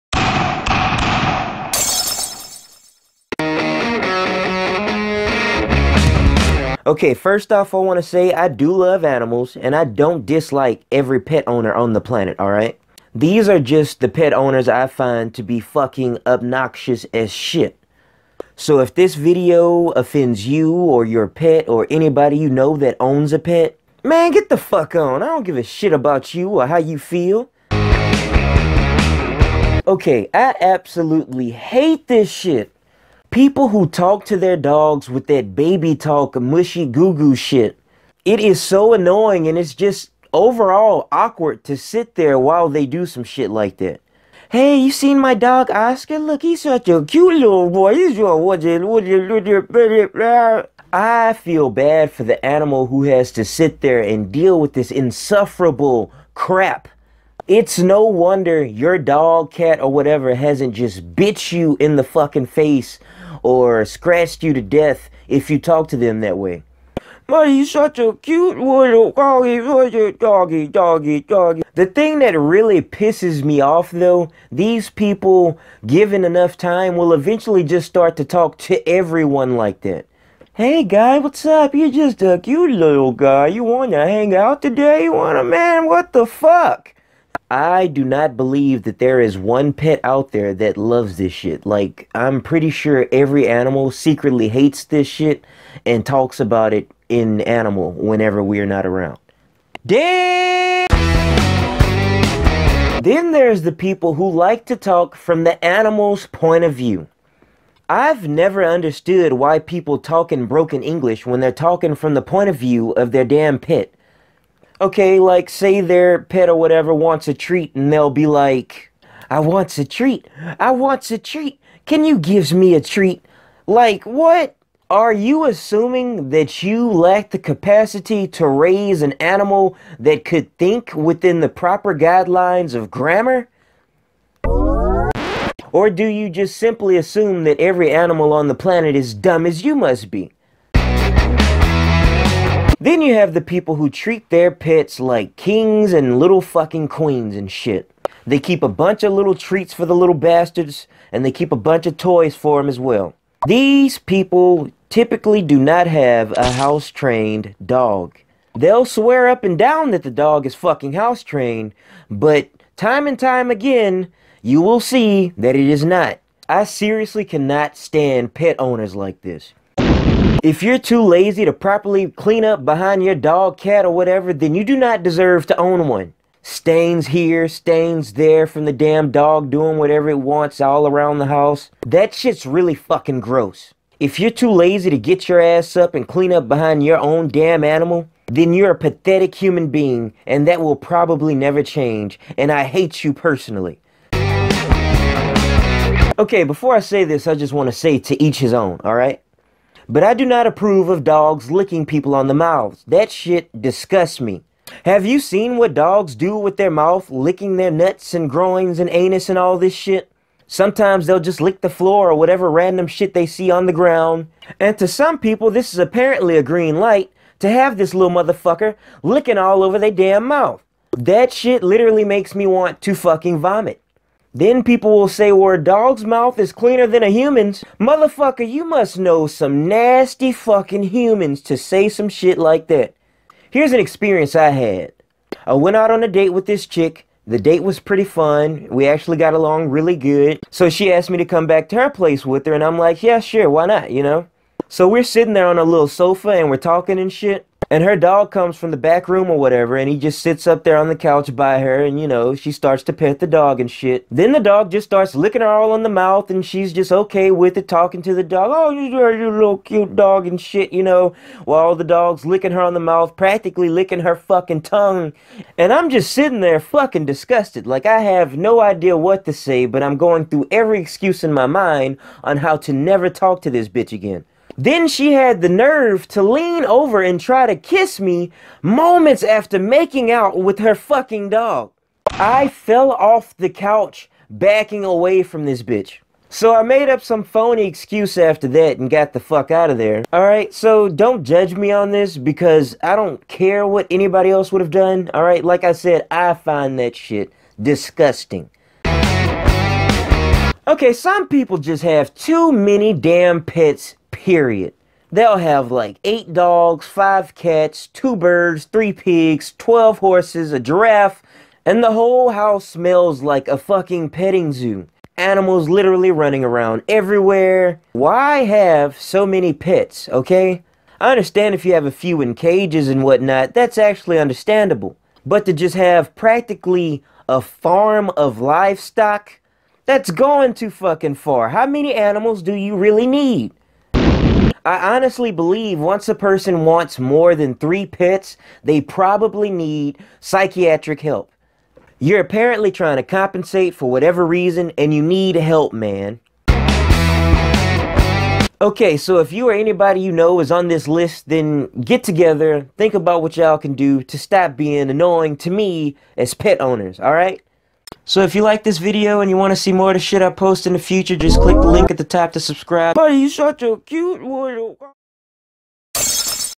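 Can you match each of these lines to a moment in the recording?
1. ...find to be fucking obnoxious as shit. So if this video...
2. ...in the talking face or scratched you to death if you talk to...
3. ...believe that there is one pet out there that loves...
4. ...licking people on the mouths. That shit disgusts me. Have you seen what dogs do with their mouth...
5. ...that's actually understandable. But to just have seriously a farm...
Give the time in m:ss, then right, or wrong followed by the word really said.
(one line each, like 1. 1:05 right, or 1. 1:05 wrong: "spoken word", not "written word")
1. 0:14 right
2. 1:01 wrong: "fucking", not "talking"
3. 1:28 right
4. 3:21 right
5. 5:23 wrong: "practically", not "seriously".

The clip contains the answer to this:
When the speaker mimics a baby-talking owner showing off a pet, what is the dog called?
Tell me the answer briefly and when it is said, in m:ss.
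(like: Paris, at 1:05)
Oscar, at 0:45.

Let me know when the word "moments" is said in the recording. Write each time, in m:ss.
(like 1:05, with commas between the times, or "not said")
4:38.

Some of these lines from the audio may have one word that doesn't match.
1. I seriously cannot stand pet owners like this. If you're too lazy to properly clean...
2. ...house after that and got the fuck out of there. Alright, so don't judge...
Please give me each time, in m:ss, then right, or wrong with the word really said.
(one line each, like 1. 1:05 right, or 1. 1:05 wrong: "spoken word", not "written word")
1. 2:46 right
2. 4:47 wrong: "excuse", not "house".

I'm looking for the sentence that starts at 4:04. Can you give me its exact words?
So we're sitting there on a little sofa and we're talking and shit.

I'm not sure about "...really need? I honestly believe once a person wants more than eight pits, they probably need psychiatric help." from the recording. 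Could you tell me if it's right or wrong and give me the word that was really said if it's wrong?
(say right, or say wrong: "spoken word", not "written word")
wrong: "three", not "eight".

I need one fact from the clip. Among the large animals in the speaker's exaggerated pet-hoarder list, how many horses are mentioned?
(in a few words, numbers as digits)
12.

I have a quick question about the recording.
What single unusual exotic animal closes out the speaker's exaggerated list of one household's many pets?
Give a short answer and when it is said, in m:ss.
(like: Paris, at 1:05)
A giraffe, at 5:10.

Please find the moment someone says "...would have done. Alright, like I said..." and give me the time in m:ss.
4:54.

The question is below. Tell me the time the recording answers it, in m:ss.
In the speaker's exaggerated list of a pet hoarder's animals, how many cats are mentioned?
5:06.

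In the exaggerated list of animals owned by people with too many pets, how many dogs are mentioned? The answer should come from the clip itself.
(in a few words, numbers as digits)
8.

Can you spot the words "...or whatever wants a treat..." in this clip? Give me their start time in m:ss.
1:56.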